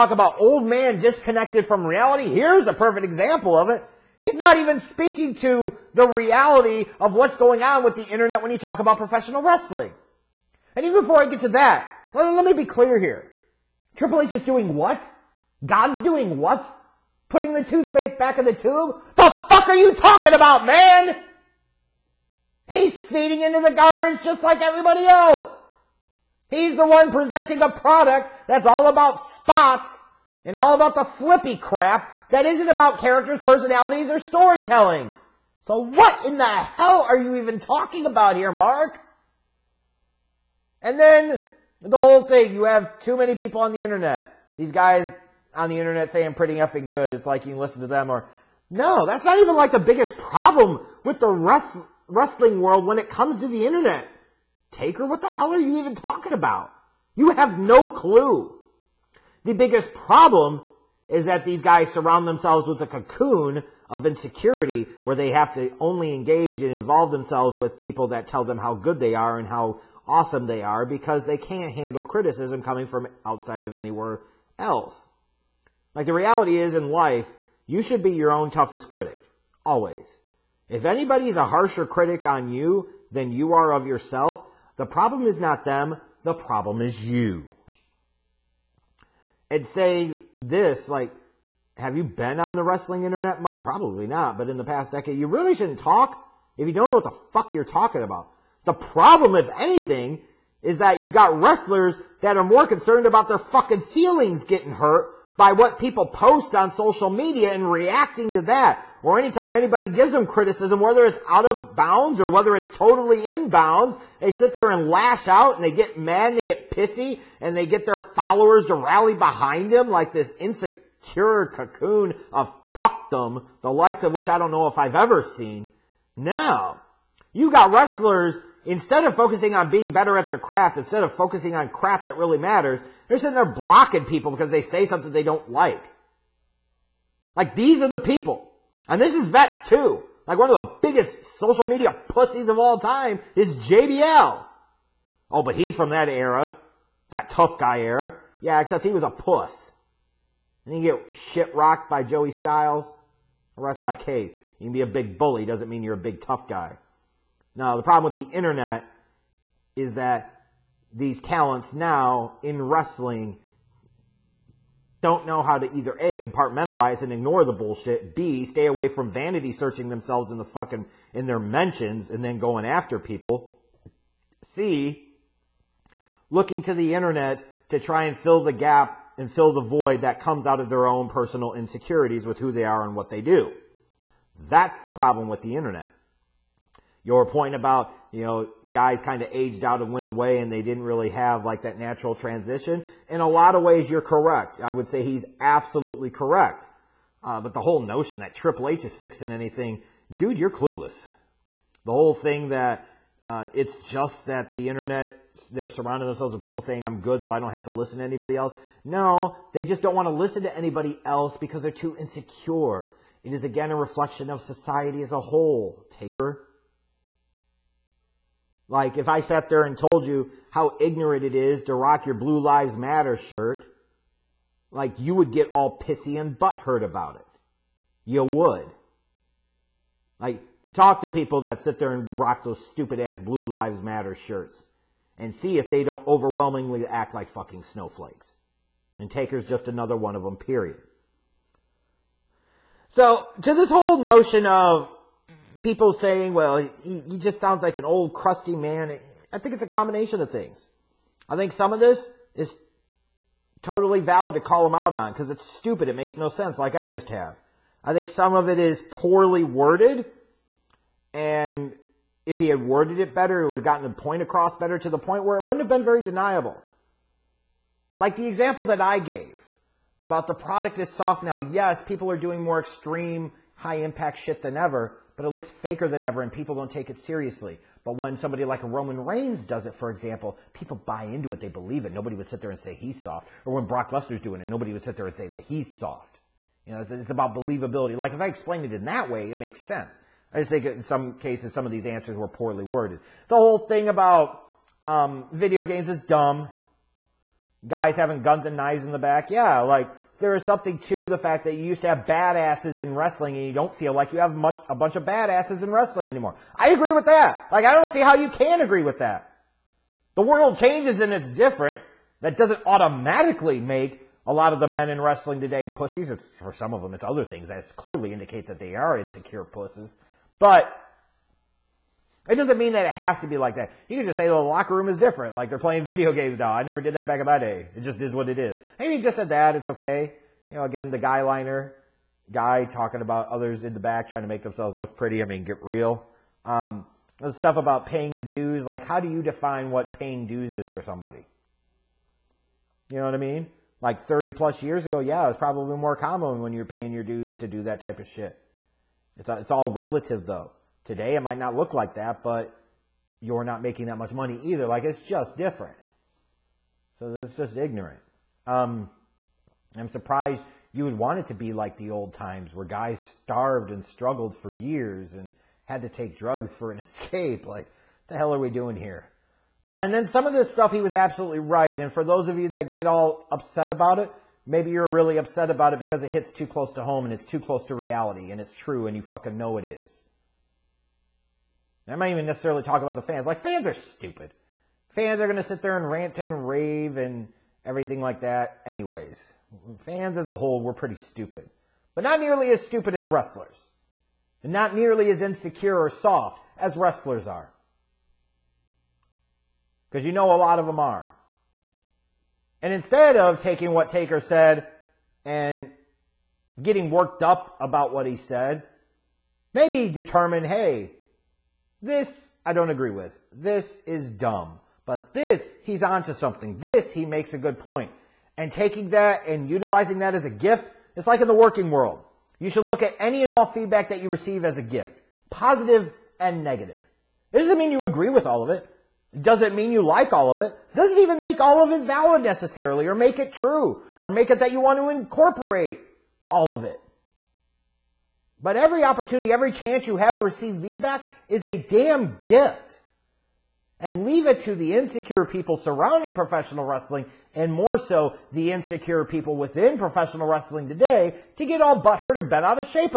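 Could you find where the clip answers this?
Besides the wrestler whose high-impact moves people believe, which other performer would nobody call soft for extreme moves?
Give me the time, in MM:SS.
04:43.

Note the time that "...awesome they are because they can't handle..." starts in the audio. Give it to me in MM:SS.
01:10.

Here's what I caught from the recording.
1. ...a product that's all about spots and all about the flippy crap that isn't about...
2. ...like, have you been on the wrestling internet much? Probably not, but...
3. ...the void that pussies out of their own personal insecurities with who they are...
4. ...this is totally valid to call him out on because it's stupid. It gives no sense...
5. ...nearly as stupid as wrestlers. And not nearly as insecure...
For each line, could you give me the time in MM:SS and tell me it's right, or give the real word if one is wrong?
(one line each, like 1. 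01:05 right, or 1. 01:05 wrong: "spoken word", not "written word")
1. 00:27 right
2. 01:30 right
3. 02:59 wrong: "comes", not "pussies"
4. 04:11 wrong: "makes", not "gives"
5. 06:32 right.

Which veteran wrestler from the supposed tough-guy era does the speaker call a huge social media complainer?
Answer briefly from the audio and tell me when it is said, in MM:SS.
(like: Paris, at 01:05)
JBL, at 02:23.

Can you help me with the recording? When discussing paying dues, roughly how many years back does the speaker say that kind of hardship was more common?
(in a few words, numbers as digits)
30 plus years.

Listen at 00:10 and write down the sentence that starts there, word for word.
And even before I get to that, let, me be clear here.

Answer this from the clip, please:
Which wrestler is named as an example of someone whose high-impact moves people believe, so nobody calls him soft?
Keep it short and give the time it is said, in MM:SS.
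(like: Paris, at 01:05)
Roman Reigns, at 04:38.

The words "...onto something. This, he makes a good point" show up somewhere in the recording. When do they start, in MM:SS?
06:55.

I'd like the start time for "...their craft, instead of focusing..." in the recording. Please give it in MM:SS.
02:10.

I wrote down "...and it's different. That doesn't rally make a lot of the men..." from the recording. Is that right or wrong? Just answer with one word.
wrong.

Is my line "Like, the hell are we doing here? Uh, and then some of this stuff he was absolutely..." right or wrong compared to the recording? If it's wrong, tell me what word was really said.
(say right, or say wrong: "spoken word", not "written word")
right.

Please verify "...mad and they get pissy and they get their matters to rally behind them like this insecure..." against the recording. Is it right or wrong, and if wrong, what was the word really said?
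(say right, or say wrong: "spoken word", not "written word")
wrong: "followers", not "matters".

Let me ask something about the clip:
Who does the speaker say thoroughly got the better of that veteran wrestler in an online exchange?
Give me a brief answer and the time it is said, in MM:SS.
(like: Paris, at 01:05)
Joey Styles, at 02:32.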